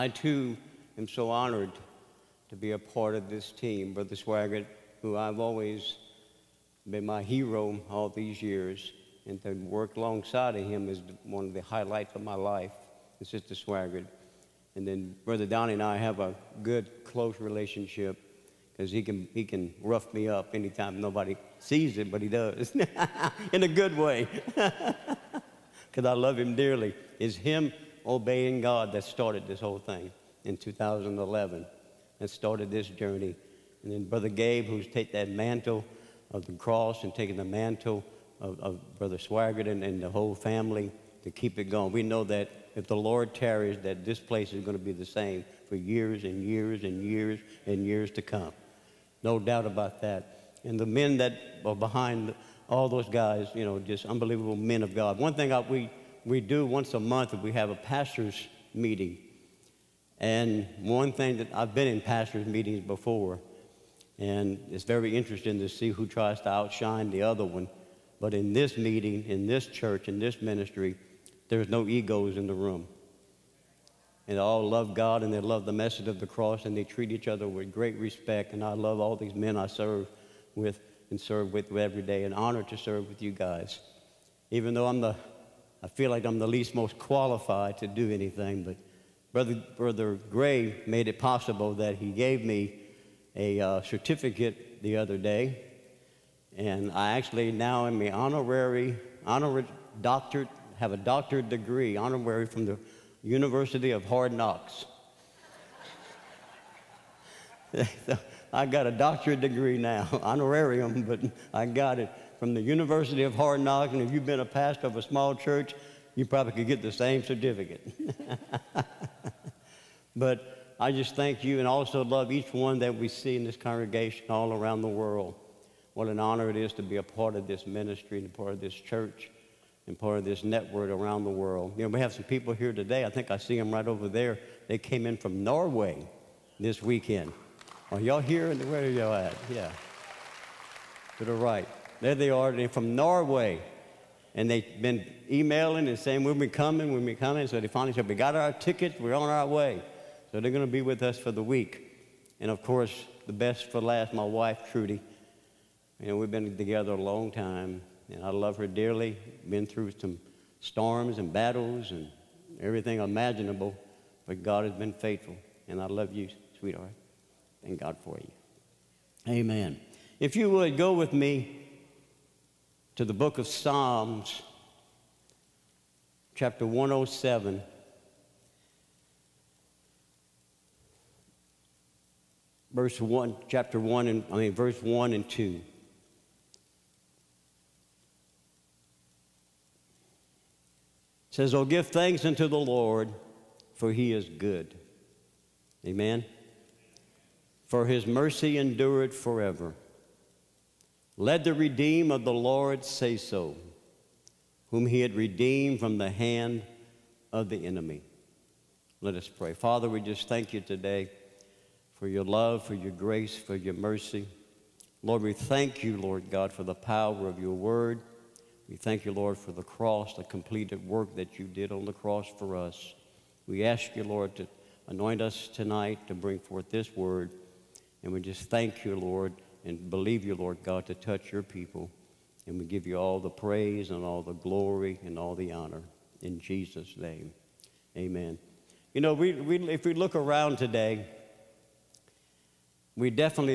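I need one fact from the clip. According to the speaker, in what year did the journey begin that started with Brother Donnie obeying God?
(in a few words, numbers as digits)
2011.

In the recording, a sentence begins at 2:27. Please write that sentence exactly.
So they finally said, we got our tickets, we're on our way.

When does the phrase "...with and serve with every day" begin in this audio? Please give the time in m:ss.
1:20.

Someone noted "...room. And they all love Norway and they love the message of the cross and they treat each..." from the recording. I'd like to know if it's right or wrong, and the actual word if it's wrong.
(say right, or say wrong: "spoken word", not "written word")
wrong: "God", not "Norway".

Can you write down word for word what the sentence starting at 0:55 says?
One thing I, we, we do once a month, we have a pastor's meeting.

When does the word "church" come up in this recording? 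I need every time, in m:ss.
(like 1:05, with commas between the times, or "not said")
1:09, 1:55, 2:08.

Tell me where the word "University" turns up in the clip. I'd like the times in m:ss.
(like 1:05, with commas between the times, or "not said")
1:43, 1:52.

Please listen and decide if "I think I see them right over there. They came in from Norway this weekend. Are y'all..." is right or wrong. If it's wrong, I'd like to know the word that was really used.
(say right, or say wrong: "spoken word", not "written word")
right.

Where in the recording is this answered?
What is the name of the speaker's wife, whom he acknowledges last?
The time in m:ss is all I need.
2:34.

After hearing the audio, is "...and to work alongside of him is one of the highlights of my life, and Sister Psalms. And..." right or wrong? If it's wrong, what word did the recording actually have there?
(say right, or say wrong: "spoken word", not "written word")
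wrong: "Swaggart", not "Psalms".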